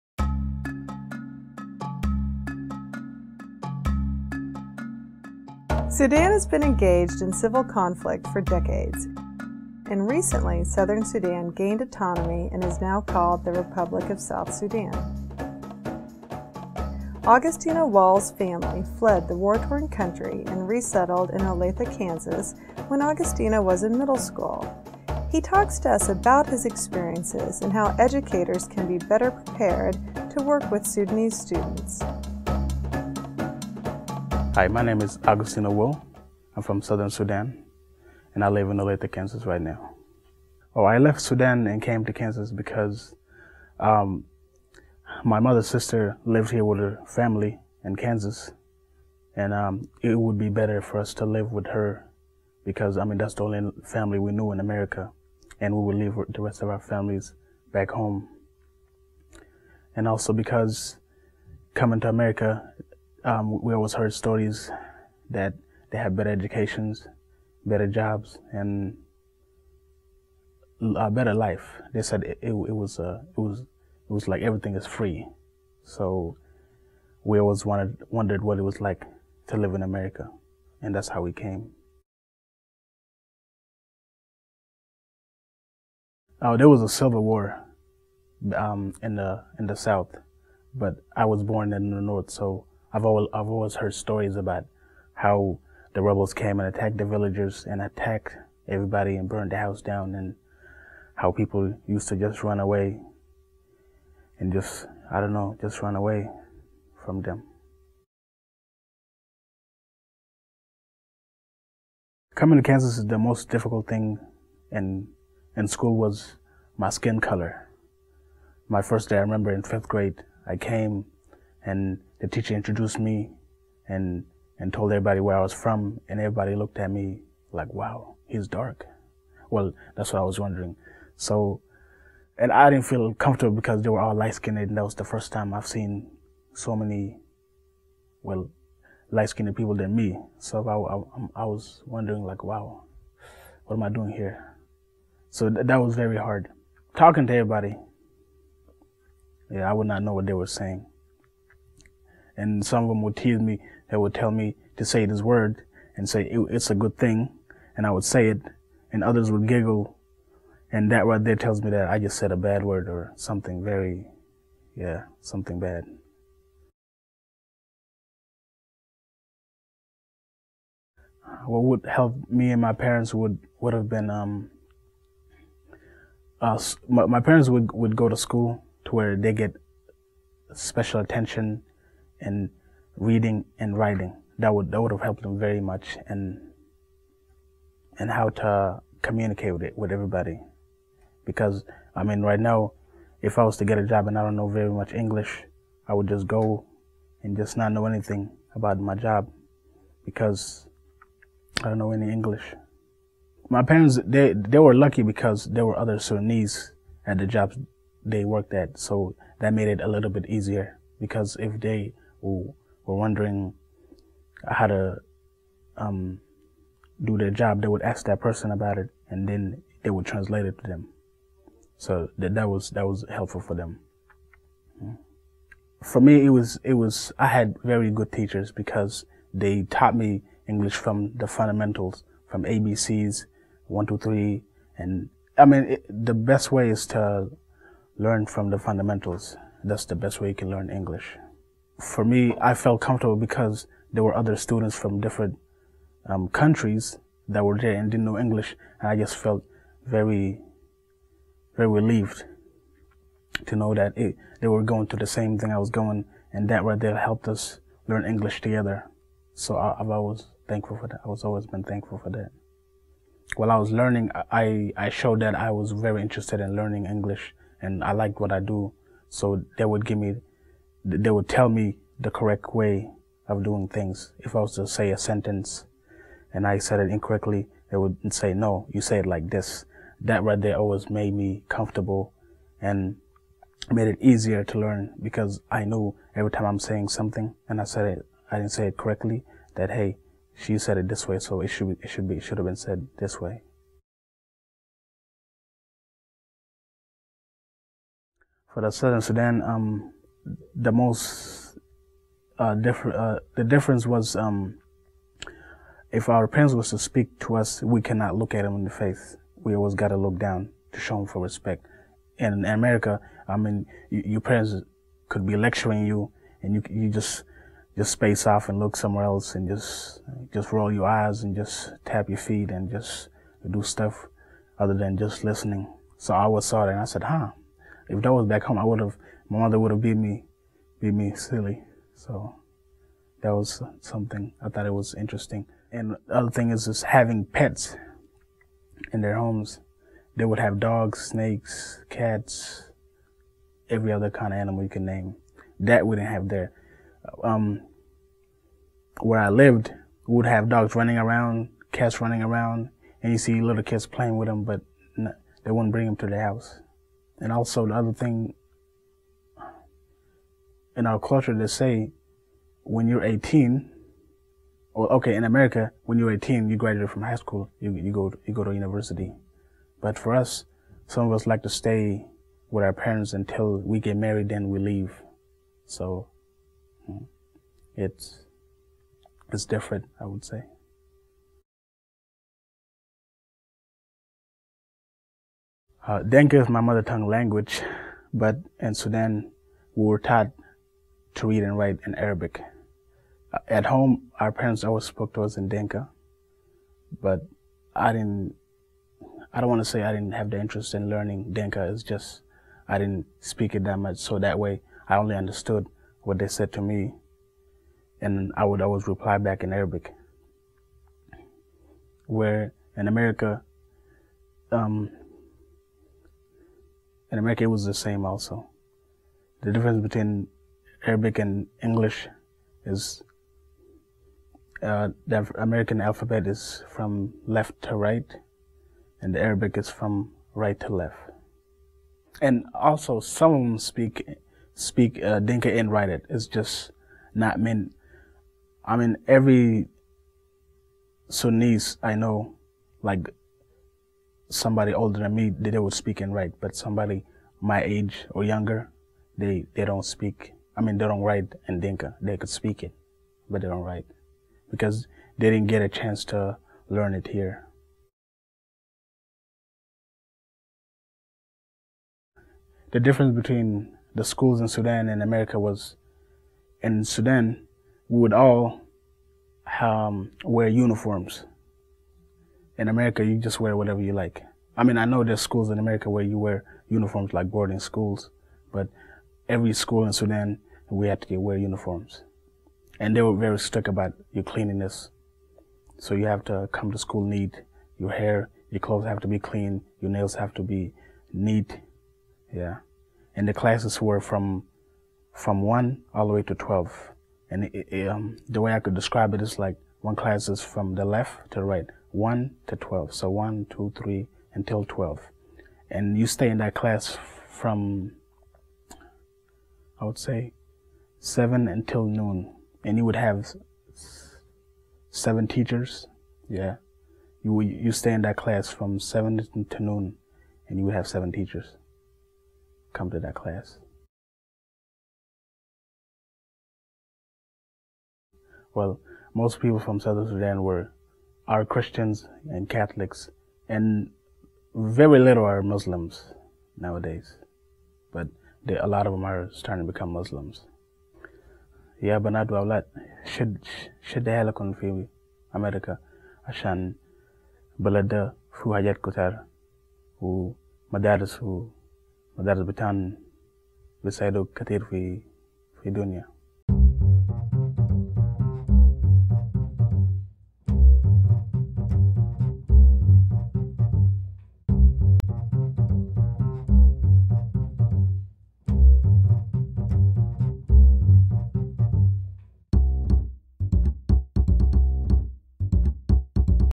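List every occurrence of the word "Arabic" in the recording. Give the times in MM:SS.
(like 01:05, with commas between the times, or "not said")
06:31, 06:49, 07:00, 07:09.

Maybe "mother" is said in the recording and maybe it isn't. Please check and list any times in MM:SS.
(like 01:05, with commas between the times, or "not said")
00:45, 05:29, 06:26.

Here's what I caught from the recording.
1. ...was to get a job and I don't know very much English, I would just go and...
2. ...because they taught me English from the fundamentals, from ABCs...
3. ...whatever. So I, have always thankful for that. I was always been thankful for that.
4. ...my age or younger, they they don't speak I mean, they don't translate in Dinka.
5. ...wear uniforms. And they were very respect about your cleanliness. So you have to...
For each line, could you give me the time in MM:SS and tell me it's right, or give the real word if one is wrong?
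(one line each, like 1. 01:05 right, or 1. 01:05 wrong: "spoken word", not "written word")
1. 03:13 right
2. 03:48 right
3. 04:18 wrong: "together", not "whatever"
4. 07:27 wrong: "write", not "translate"
5. 08:01 wrong: "strict", not "respect".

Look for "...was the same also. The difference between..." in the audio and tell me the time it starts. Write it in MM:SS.
06:57.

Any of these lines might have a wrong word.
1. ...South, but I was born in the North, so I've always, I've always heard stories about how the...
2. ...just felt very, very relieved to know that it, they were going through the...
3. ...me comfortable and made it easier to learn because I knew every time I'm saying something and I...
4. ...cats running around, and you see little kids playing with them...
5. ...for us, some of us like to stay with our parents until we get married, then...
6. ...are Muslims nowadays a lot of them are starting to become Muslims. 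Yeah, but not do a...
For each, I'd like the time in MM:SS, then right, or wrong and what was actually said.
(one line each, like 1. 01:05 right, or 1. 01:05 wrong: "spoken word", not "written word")
1. 01:29 right
2. 04:08 right
3. 04:41 right
4. 05:51 right
5. 06:09 right
6. 08:55 right.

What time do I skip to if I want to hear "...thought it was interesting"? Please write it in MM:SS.
05:34.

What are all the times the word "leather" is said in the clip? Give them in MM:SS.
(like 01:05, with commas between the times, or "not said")
not said.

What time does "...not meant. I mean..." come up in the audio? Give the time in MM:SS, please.
07:17.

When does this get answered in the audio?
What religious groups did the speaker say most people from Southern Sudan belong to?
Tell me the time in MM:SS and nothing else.
08:51.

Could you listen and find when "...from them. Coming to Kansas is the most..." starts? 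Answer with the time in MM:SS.
01:47.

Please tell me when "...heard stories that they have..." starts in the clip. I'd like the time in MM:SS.
01:03.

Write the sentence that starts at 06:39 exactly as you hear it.
I don't want to say I didn't have the interest in learning Dinka.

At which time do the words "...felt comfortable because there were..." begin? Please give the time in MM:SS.
04:02.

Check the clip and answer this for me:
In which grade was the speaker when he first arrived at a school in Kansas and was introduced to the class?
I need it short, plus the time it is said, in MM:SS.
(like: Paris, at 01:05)
fifth grade, at 01:59.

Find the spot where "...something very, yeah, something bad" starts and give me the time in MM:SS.
02:43.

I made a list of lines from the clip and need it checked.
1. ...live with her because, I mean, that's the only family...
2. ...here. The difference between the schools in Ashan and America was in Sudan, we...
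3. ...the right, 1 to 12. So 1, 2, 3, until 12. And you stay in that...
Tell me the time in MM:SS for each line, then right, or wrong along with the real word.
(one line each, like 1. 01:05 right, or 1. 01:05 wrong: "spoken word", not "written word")
1. 00:51 right
2. 07:37 wrong: "Sudan", not "Ashan"
3. 08:21 right.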